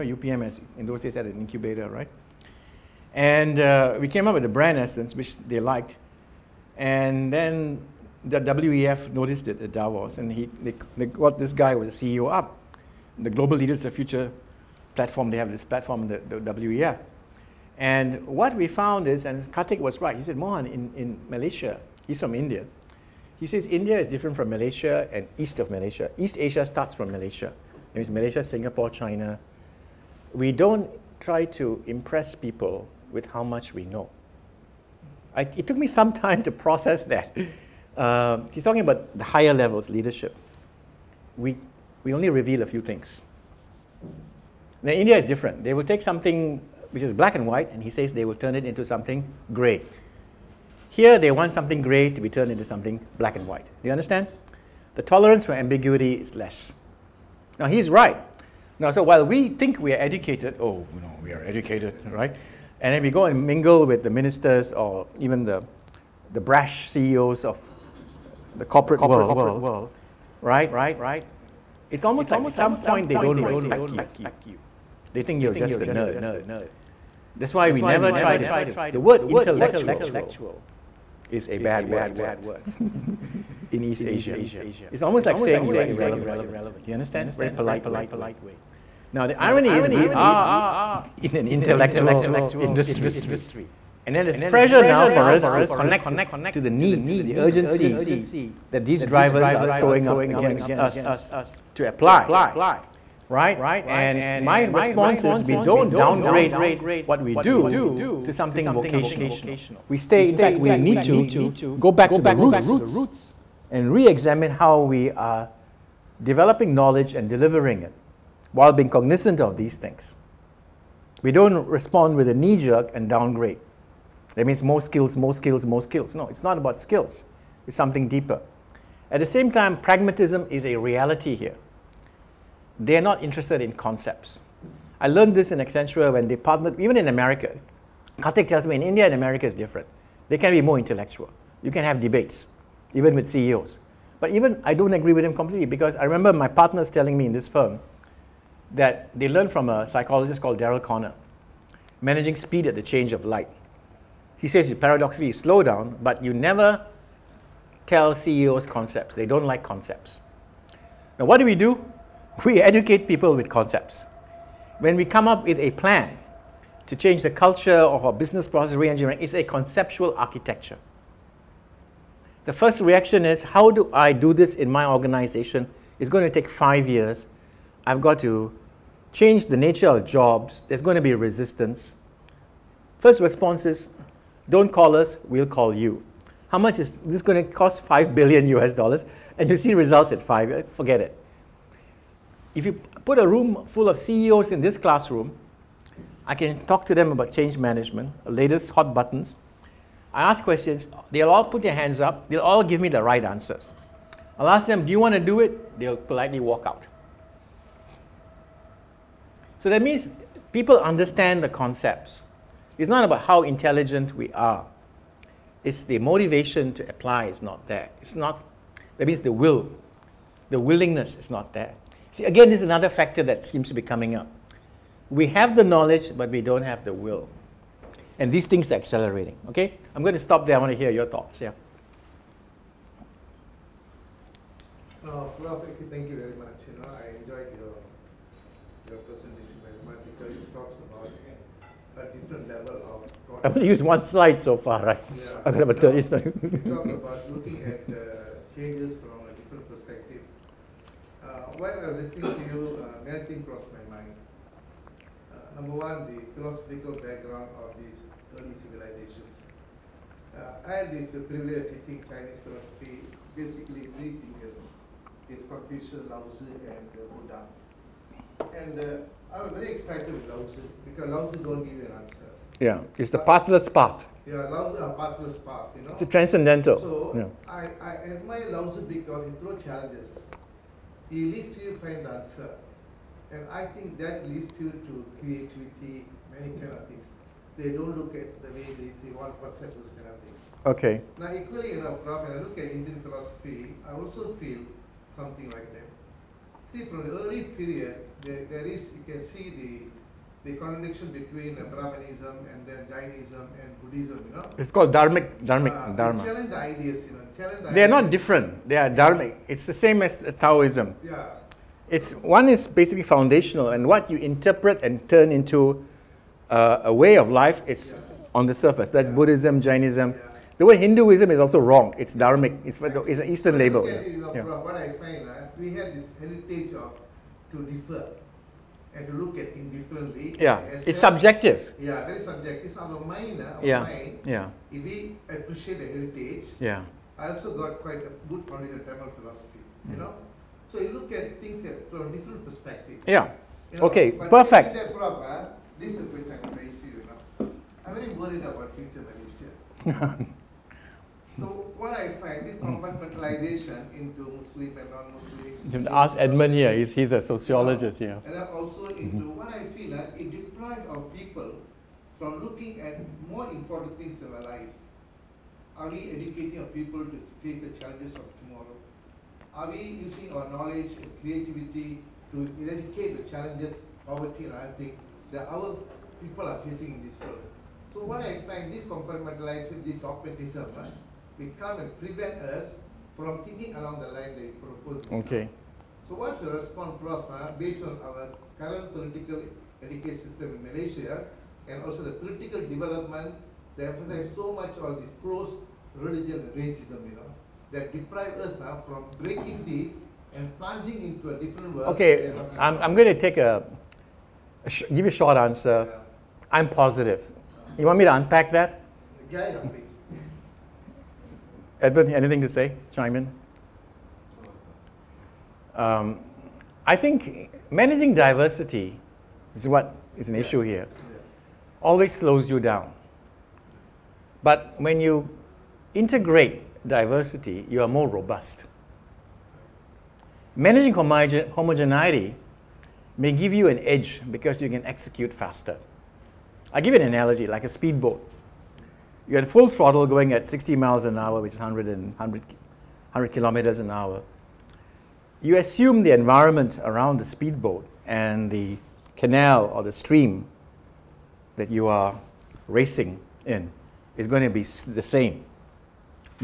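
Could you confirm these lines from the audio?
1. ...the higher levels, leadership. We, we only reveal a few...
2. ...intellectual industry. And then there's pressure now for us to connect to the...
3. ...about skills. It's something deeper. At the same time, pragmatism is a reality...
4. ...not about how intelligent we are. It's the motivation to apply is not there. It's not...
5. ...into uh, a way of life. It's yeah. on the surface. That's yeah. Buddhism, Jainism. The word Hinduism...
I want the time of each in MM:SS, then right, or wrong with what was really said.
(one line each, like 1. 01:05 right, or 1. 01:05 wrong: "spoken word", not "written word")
1. 00:39 right
2. 01:31 right
3. 02:06 right
4. 03:32 right
5. 05:15 right.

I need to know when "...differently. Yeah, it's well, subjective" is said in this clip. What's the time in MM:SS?
05:29.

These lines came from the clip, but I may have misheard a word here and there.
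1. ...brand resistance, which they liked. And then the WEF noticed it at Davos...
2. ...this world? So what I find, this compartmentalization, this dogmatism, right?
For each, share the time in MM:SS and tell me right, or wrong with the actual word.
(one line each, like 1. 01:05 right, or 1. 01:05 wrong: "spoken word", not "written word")
1. 00:04 wrong: "essence", not "resistance"
2. 06:17 right.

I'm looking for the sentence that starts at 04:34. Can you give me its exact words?
Yeah, love the pathless path, you know.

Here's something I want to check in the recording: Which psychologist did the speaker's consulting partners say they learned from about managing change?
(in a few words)
Daryl Conner.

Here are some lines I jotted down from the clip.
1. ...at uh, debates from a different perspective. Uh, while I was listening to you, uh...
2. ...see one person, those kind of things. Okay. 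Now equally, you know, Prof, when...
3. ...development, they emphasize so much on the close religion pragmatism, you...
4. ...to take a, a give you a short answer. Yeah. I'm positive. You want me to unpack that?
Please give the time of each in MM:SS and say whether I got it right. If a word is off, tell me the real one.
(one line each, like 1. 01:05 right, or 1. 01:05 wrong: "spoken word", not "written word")
1. 04:07 wrong: "changes", not "debates"
2. 04:48 right
3. 06:32 wrong: "racism", not "pragmatism"
4. 06:43 right.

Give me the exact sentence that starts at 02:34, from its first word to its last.
He says, paradoxically, slow down, but you never tell CEOs concepts.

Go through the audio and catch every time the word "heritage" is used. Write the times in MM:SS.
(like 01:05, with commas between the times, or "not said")
05:26, 05:35.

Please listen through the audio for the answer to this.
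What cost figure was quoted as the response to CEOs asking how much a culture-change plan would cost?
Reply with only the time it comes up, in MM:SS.
03:07.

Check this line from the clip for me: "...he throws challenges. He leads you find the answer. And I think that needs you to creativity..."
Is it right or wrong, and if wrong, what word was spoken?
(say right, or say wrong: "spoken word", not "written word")
wrong: "leads", not "needs".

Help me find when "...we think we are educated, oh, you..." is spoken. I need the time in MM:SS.
00:59.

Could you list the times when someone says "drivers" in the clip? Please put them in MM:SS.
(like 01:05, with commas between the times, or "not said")
01:39.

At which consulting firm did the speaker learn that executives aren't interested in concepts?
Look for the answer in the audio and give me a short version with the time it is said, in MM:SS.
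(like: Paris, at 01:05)
Accenture, at 02:15.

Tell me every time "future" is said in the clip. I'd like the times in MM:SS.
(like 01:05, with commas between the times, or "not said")
00:13, 05:48.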